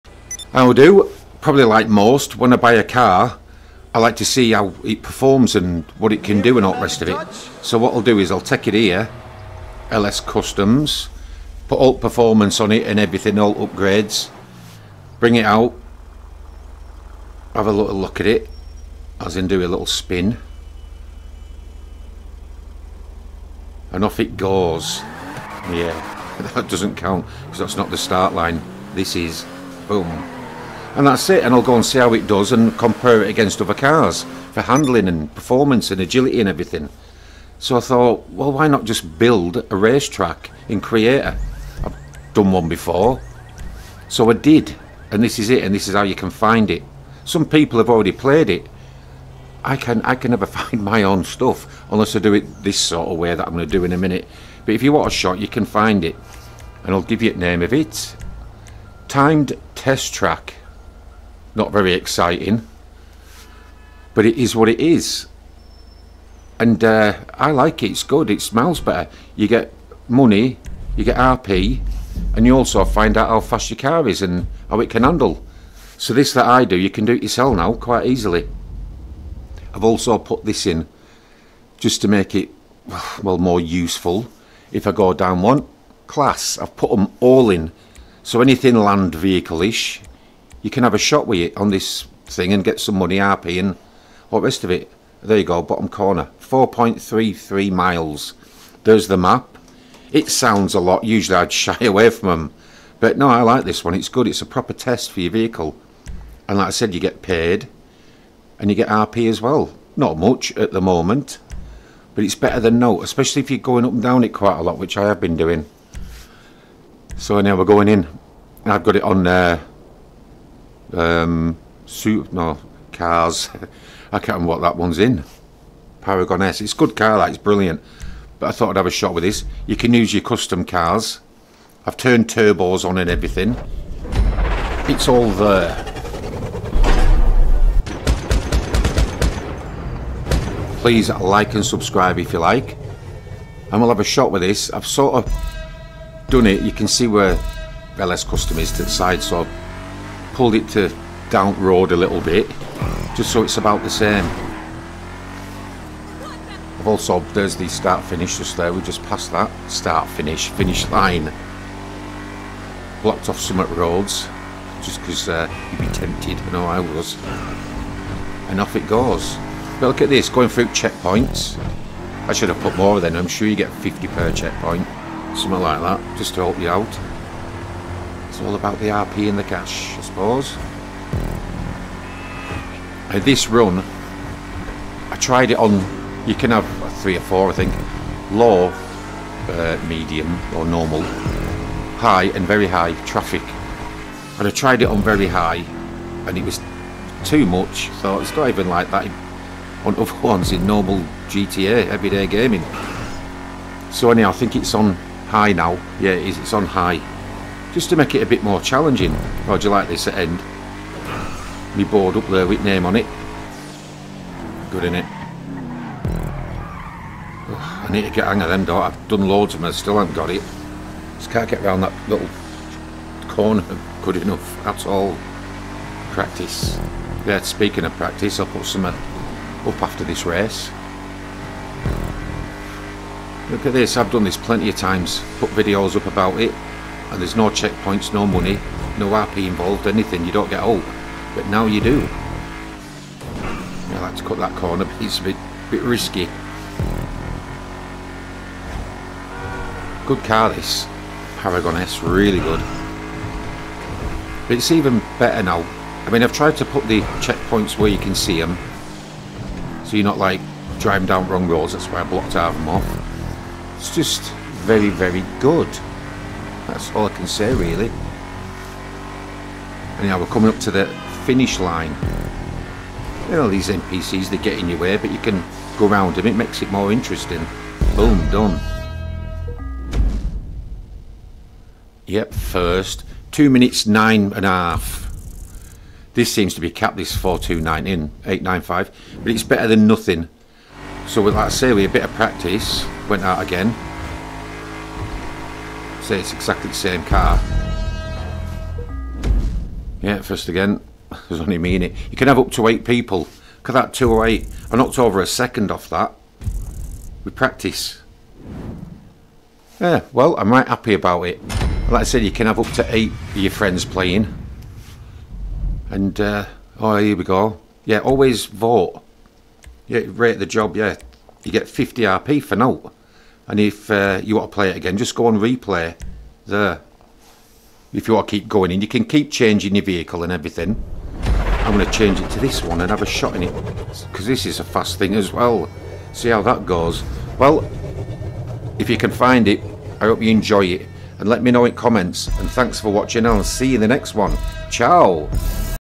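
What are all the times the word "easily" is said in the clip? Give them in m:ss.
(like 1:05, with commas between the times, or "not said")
1:18.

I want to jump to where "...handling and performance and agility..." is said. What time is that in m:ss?
0:34.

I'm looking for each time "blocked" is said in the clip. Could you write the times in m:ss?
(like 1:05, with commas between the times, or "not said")
2:43, 4:22.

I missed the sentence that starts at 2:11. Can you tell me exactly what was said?
I've turned turbos on and everything.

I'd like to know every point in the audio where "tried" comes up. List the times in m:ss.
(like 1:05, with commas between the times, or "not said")
3:05, 3:14, 4:16.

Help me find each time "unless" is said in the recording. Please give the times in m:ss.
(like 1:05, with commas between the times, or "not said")
0:51.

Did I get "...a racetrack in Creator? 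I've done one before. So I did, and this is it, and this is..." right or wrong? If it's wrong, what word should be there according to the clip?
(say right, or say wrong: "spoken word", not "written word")
right.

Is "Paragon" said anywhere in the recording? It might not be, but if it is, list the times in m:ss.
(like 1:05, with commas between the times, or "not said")
2:06, 4:11.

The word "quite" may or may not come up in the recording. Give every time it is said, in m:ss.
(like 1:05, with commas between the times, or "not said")
1:17, 1:54.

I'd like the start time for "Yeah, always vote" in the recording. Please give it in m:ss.
5:17.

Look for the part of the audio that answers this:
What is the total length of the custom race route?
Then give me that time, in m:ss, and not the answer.
1:36.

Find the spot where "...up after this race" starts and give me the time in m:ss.
3:48.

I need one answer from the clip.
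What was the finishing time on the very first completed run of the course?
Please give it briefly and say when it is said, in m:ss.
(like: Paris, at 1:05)
2 minutes 9.5 seconds, at 4:43.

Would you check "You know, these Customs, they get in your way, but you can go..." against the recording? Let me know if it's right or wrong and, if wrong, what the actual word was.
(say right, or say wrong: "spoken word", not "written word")
wrong: "NPCs", not "Customs".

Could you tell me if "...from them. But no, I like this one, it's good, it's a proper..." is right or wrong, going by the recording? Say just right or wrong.
right.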